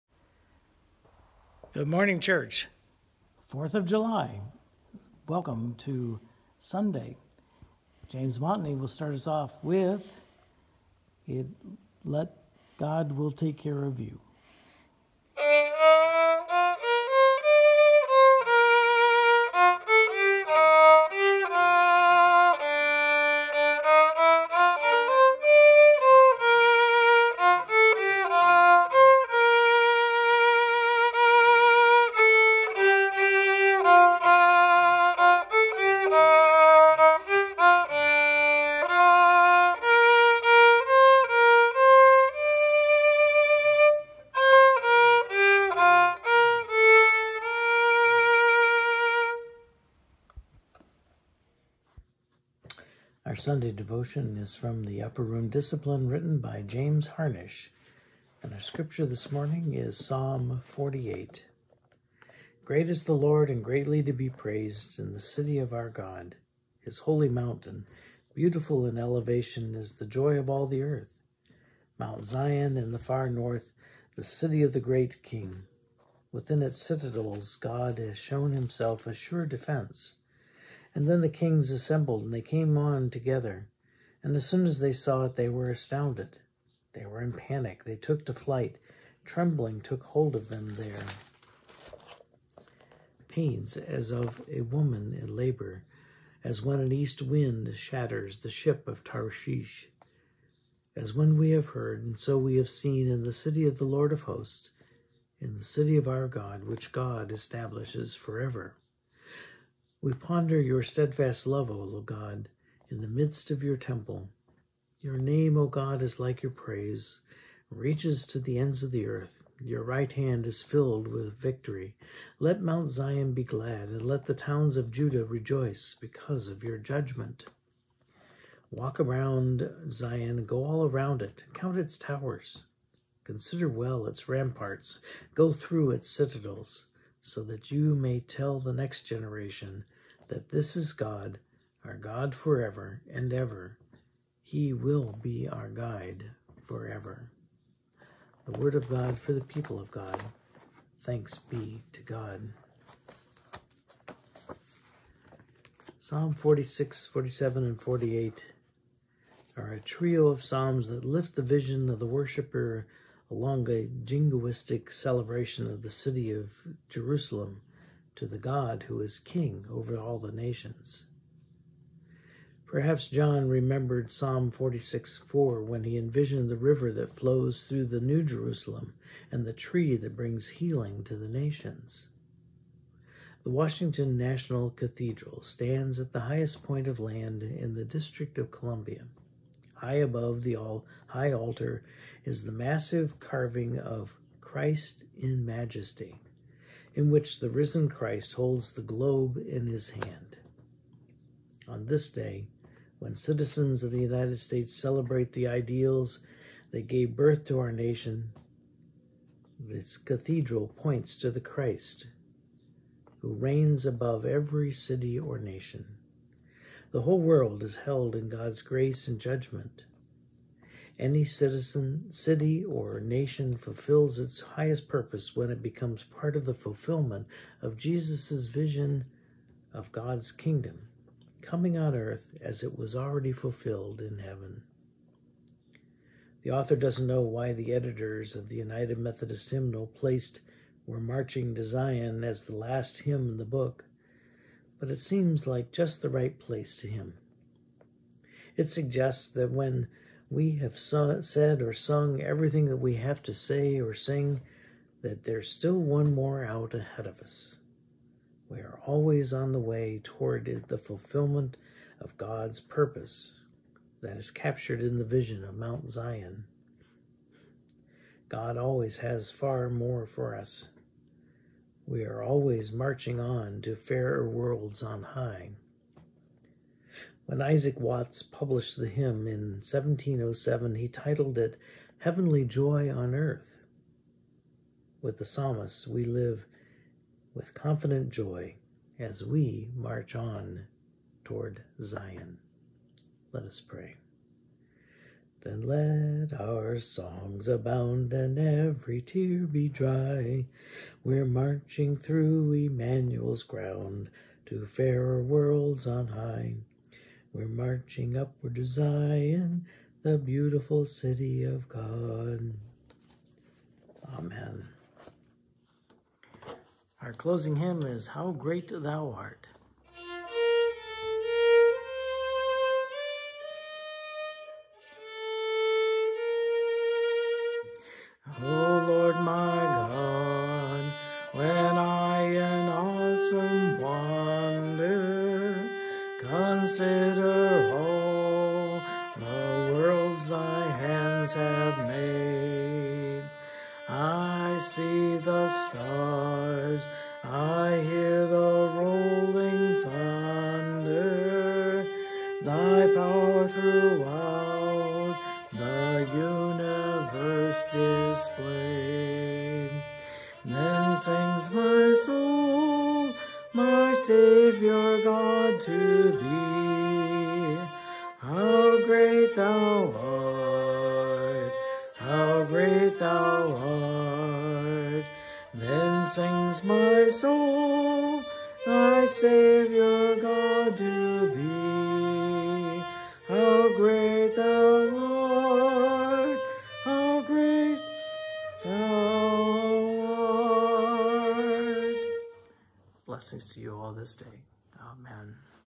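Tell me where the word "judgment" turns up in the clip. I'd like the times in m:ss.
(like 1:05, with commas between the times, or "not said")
2:06, 3:39.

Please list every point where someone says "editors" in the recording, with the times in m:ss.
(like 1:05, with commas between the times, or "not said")
3:57.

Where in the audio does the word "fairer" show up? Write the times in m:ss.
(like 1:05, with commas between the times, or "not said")
4:33, 5:04.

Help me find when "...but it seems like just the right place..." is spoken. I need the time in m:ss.
4:04.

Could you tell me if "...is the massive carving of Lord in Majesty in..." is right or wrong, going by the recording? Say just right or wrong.
wrong.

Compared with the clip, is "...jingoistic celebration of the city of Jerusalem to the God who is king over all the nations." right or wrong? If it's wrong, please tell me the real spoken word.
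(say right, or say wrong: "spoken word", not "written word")
right.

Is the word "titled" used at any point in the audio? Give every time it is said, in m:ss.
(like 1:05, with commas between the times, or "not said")
4:40.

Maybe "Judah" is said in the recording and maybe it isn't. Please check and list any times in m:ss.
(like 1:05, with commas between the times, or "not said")
2:04.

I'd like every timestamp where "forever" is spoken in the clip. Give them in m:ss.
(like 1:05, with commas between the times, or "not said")
1:48, 2:22, 2:26.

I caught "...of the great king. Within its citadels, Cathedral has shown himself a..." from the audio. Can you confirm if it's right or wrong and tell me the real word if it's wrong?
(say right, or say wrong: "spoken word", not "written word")
wrong: "God", not "Cathedral".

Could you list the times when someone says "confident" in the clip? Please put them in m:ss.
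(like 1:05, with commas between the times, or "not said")
4:47.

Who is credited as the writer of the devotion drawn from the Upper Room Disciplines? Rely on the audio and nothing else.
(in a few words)
James Harnish.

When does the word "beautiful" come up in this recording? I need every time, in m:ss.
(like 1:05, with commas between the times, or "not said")
1:08, 5:10.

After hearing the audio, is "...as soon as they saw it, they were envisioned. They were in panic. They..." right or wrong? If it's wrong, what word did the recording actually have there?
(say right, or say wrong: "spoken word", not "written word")
wrong: "astounded", not "envisioned".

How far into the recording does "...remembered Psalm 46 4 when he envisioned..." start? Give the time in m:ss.
2:53.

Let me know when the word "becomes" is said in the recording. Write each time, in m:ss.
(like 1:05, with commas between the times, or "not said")
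3:45.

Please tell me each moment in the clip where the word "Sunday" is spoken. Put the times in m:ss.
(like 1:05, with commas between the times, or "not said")
0:06, 0:53.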